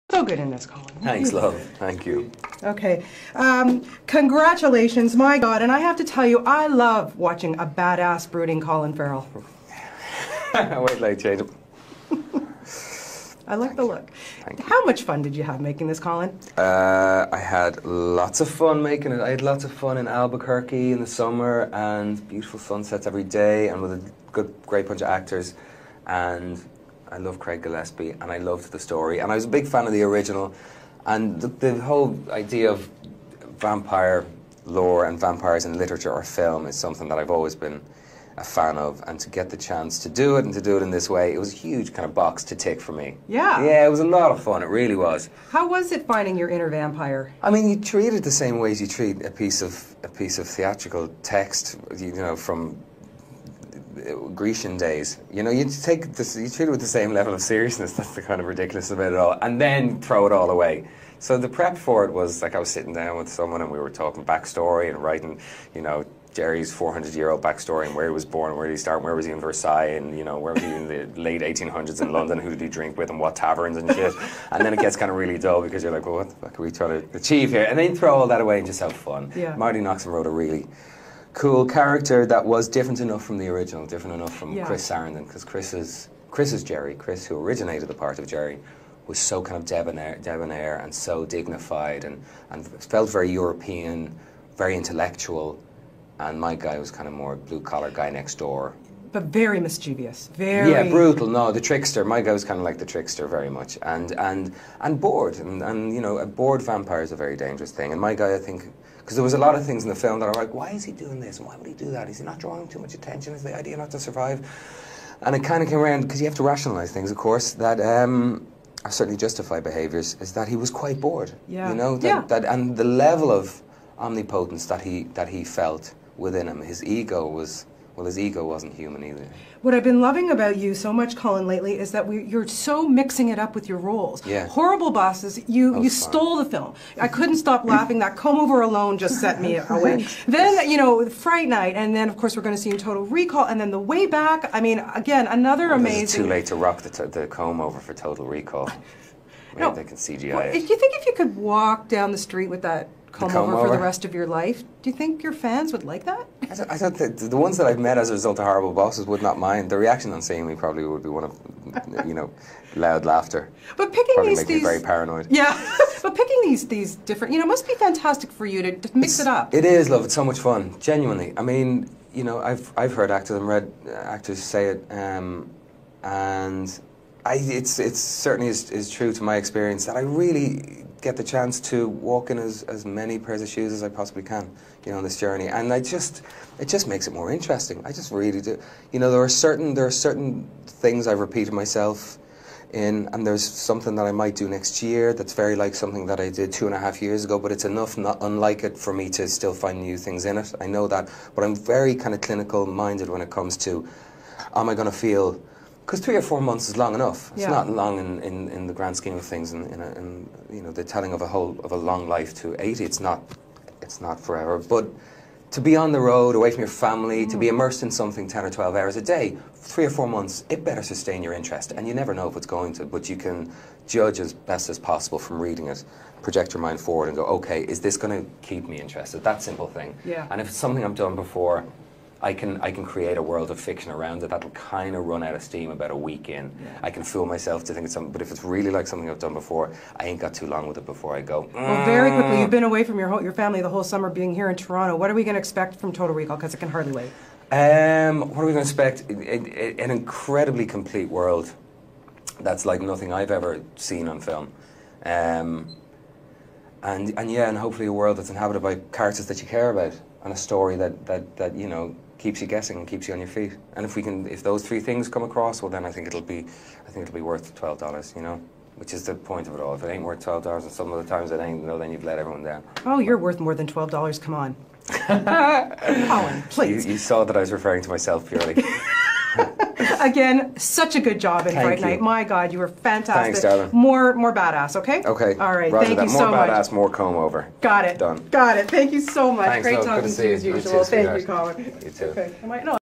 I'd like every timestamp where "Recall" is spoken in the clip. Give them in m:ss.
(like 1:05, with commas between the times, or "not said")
2:23, 2:28, 4:06.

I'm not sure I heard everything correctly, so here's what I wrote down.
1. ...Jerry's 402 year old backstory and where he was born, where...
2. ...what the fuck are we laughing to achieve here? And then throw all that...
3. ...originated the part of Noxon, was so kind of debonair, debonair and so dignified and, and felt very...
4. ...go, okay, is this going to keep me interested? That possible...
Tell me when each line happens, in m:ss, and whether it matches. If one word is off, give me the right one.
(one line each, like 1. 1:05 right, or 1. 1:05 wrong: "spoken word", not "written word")
1. 1:06 wrong: "400", not "402"
2. 1:16 wrong: "trying", not "laughing"
3. 1:27 wrong: "Jerry", not "Noxon"
4. 3:47 wrong: "simple", not "possible".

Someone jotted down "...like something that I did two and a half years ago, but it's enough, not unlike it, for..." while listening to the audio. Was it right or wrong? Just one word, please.
right.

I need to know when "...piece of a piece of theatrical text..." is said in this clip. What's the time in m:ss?
0:49.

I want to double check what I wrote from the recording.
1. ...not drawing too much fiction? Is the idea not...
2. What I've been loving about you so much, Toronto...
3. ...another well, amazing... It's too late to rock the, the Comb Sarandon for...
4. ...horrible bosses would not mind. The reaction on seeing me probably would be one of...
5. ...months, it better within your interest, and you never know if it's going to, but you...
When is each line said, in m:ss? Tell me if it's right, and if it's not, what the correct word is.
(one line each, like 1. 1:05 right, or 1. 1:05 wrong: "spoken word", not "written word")
1. 1:52 wrong: "attention", not "fiction"
2. 2:09 wrong: "Colin", not "Toronto"
3. 2:25 wrong: "Over", not "Sarandon"
4. 2:38 right
5. 3:40 wrong: "sustain", not "within".